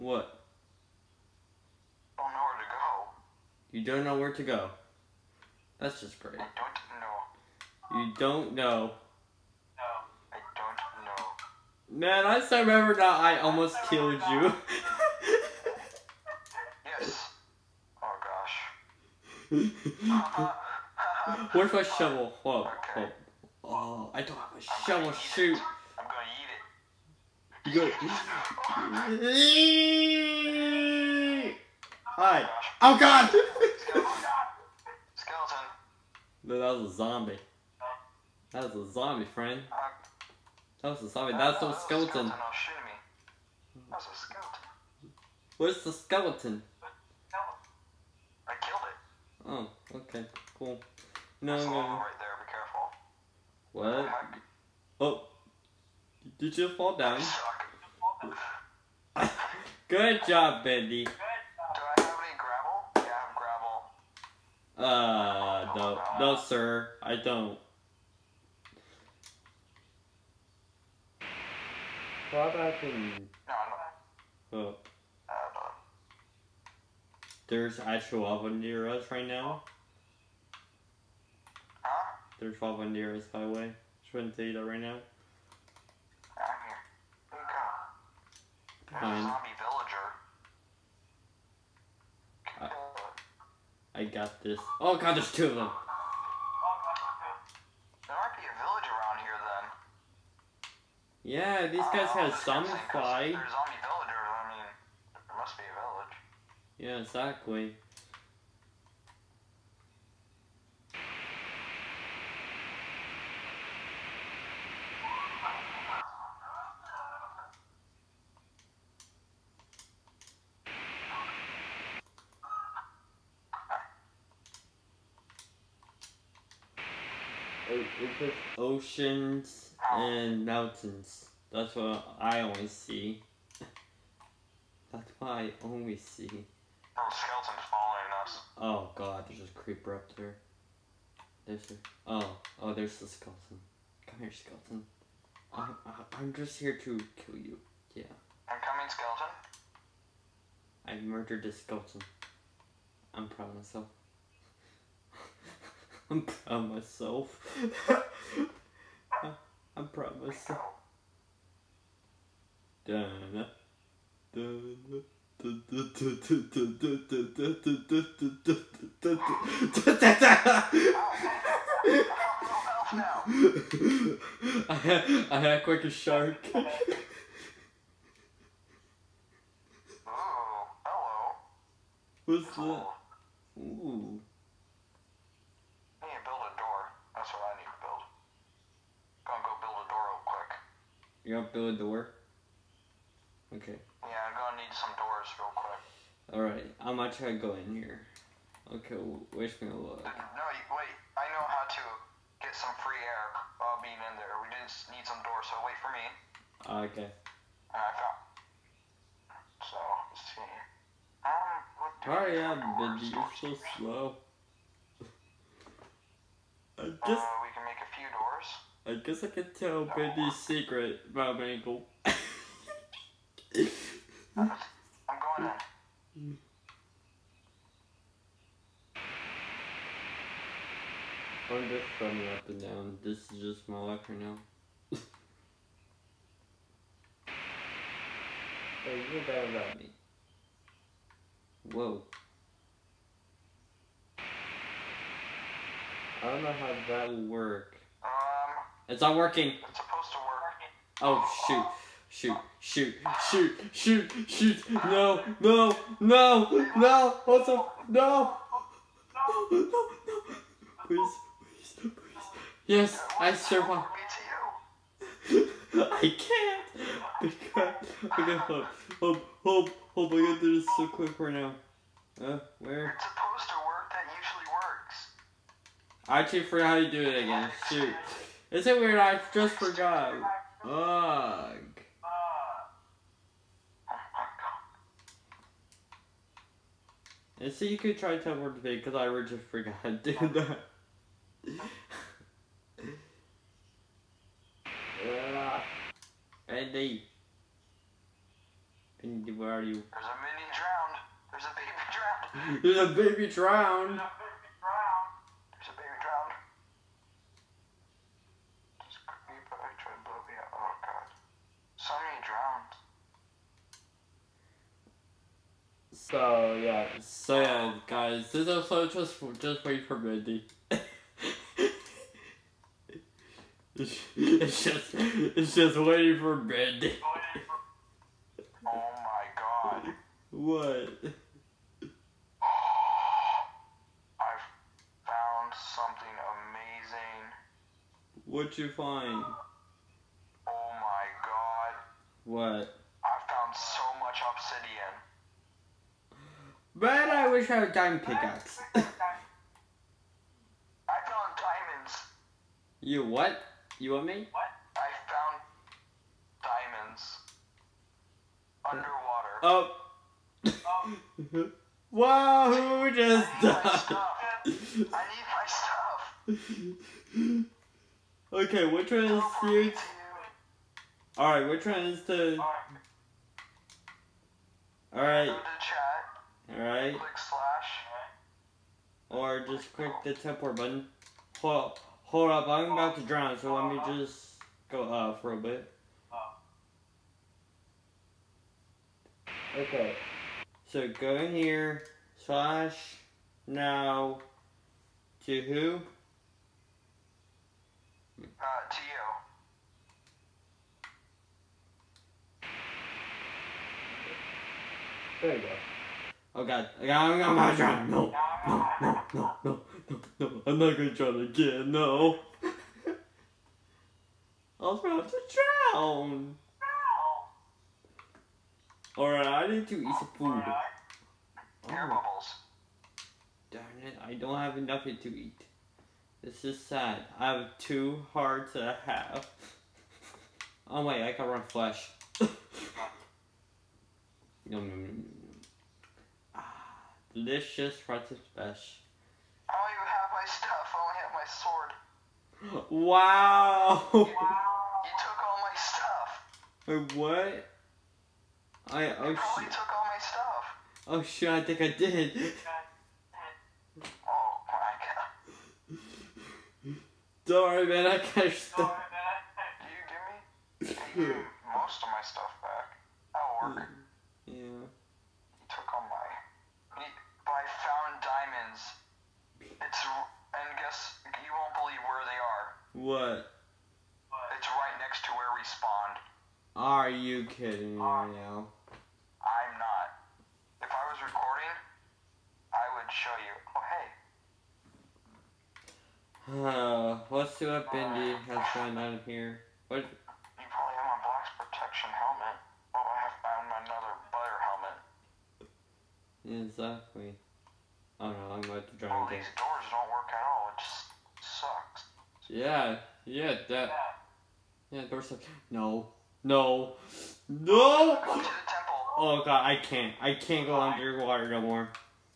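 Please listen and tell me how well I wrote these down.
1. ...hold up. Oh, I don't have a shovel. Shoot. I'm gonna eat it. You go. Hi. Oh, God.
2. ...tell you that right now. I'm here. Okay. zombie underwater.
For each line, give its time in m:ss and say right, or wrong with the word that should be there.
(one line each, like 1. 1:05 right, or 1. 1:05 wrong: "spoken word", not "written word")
1. 0:22 right
2. 1:24 wrong: "villager", not "underwater".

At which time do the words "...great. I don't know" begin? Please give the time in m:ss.
0:06.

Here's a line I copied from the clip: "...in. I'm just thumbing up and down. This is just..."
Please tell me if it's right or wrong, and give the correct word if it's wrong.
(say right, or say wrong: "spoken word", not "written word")
right.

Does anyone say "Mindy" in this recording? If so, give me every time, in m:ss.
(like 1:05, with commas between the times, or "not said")
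5:19, 5:26.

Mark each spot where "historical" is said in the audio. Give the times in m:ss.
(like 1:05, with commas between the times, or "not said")
not said.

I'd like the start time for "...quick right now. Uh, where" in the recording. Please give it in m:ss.
4:30.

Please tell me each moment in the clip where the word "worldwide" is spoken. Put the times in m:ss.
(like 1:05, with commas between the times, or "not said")
not said.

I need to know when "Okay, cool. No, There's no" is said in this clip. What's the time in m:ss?
0:49.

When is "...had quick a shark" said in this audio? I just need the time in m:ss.
2:55.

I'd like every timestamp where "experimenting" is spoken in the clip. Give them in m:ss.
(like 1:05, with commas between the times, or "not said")
not said.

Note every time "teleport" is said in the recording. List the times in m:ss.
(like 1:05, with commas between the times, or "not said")
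4:48, 6:20.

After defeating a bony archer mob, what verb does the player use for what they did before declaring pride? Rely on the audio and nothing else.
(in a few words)
murdered.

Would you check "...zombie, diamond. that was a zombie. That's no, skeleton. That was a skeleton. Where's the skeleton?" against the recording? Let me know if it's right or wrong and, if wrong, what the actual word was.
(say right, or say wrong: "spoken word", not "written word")
wrong: "friend", not "diamond".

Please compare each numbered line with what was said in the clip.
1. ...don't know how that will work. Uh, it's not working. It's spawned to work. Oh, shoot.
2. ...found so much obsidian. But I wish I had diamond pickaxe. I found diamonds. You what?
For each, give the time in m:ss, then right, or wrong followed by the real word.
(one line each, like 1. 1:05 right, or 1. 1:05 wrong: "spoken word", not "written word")
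1. 4:06 wrong: "supposed", not "spawned"
2. 5:43 right.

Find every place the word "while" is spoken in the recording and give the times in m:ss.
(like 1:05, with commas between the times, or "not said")
3:23.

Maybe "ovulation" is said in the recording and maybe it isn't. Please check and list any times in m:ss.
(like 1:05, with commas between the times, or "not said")
not said.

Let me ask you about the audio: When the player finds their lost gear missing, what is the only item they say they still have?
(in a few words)
sword.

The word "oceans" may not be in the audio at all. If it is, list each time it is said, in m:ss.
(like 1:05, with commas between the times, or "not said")
2:08.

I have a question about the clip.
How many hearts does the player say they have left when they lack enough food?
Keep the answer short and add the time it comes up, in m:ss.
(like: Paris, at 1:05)
2 and a half, at 7:07.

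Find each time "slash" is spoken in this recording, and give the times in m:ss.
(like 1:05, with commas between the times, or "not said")
6:16, 6:32.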